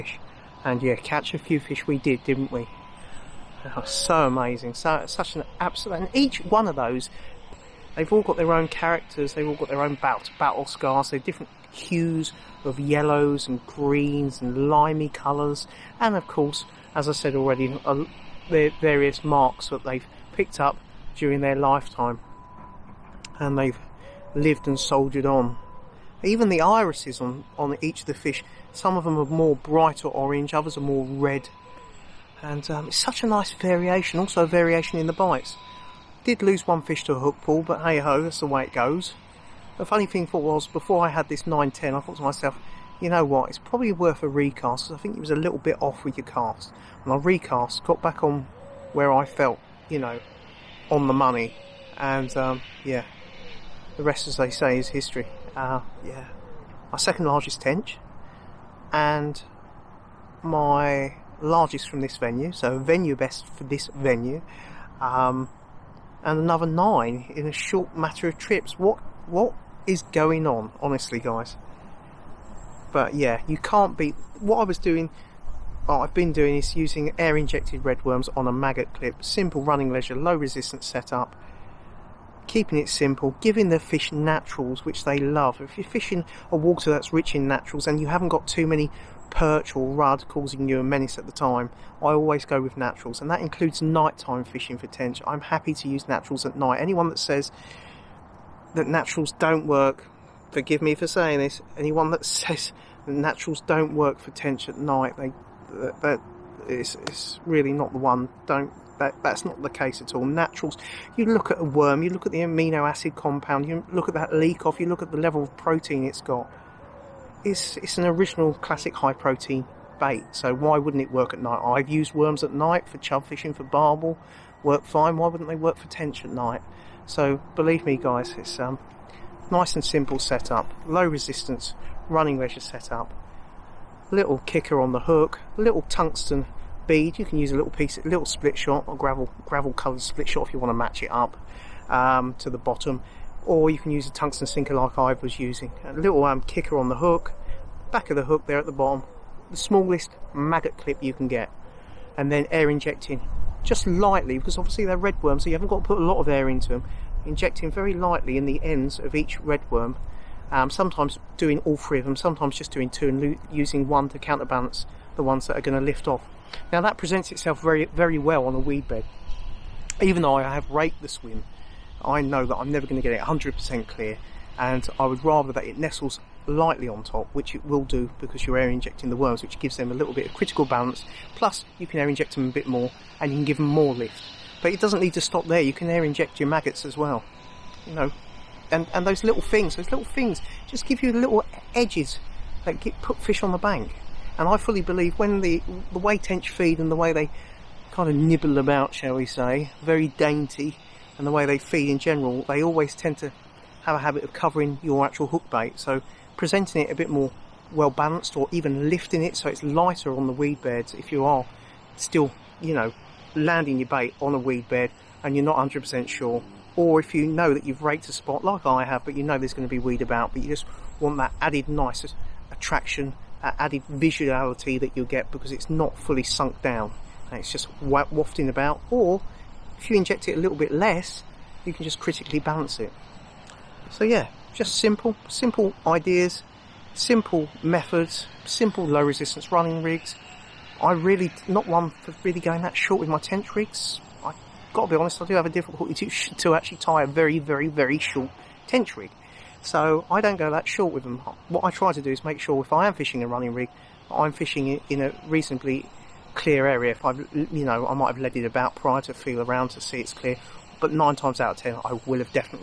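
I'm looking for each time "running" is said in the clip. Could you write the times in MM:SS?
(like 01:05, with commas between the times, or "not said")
01:19, 02:12, 03:59, 04:13.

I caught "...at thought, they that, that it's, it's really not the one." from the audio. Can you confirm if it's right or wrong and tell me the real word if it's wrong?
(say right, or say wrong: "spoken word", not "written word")
wrong: "night", not "thought".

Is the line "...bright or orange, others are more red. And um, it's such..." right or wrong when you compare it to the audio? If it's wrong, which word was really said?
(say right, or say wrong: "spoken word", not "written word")
right.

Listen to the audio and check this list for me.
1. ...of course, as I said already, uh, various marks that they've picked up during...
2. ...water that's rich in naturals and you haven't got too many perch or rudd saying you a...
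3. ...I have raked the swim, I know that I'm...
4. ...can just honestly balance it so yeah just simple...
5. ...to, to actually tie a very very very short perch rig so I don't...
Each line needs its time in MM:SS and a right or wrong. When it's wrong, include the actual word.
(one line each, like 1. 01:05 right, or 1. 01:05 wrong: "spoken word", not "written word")
1. 00:16 right
2. 01:26 wrong: "causing", not "saying"
3. 02:50 right
4. 03:51 wrong: "critically", not "honestly"
5. 04:06 wrong: "tench", not "perch".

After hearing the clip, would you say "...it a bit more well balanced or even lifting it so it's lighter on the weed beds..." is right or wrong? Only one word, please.
right.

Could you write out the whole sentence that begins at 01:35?
I'm happy to use naturals at night.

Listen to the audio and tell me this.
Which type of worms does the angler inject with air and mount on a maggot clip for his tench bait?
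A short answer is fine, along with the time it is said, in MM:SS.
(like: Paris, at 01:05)
Red worms, at 01:17.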